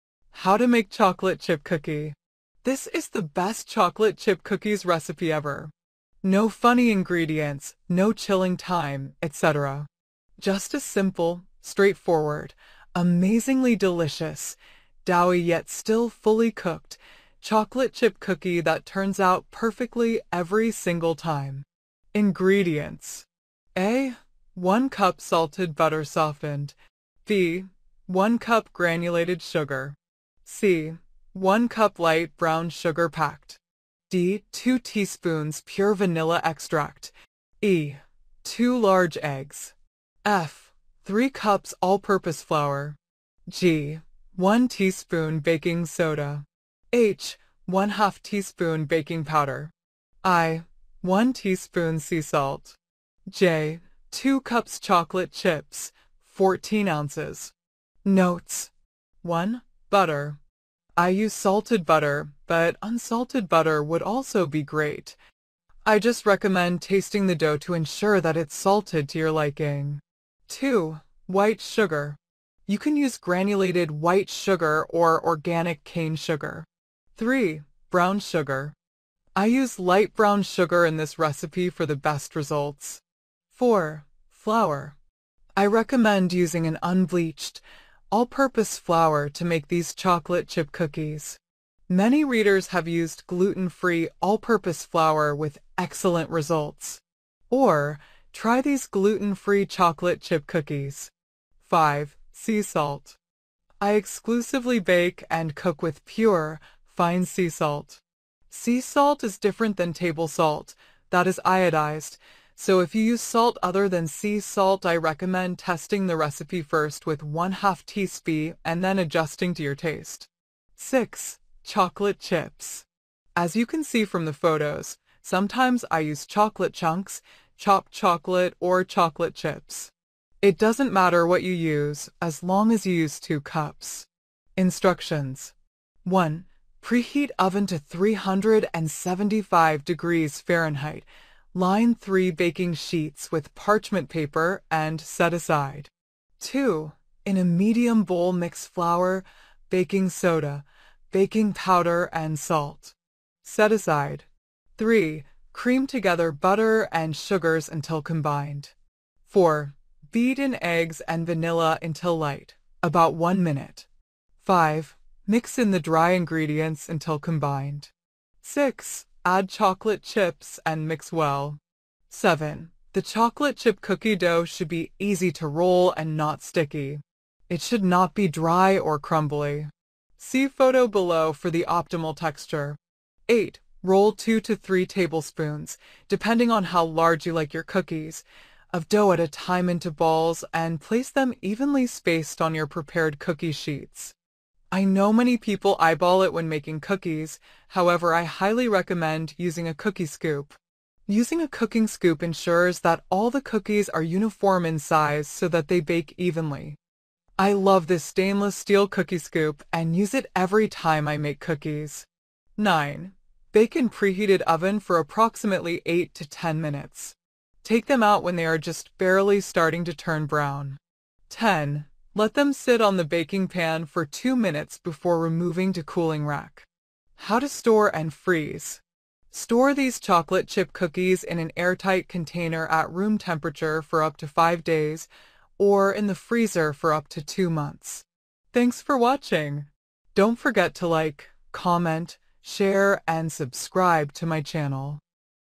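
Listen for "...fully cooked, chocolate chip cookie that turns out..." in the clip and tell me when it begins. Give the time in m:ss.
0:16.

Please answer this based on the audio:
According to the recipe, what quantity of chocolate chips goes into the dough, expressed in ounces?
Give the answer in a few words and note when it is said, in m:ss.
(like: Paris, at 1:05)
14 ounces, at 0:56.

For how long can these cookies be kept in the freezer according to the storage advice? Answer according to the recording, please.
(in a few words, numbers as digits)
2 months.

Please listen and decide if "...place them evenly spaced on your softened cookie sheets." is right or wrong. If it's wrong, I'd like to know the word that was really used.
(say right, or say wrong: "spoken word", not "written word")
wrong: "prepared", not "softened".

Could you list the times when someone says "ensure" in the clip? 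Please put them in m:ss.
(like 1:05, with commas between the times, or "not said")
1:07, 3:22.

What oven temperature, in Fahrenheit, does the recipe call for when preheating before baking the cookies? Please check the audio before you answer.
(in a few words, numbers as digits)
375 degrees.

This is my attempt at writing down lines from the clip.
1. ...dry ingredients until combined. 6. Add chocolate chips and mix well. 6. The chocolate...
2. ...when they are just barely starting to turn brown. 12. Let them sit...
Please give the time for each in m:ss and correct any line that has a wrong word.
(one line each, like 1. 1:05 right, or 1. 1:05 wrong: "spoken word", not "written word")
1. 2:45 wrong: "7", not "6"
2. 3:38 wrong: "10", not "12".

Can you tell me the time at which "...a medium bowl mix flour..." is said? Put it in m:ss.
2:27.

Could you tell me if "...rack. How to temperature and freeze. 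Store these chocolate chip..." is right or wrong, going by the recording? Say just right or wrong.
wrong.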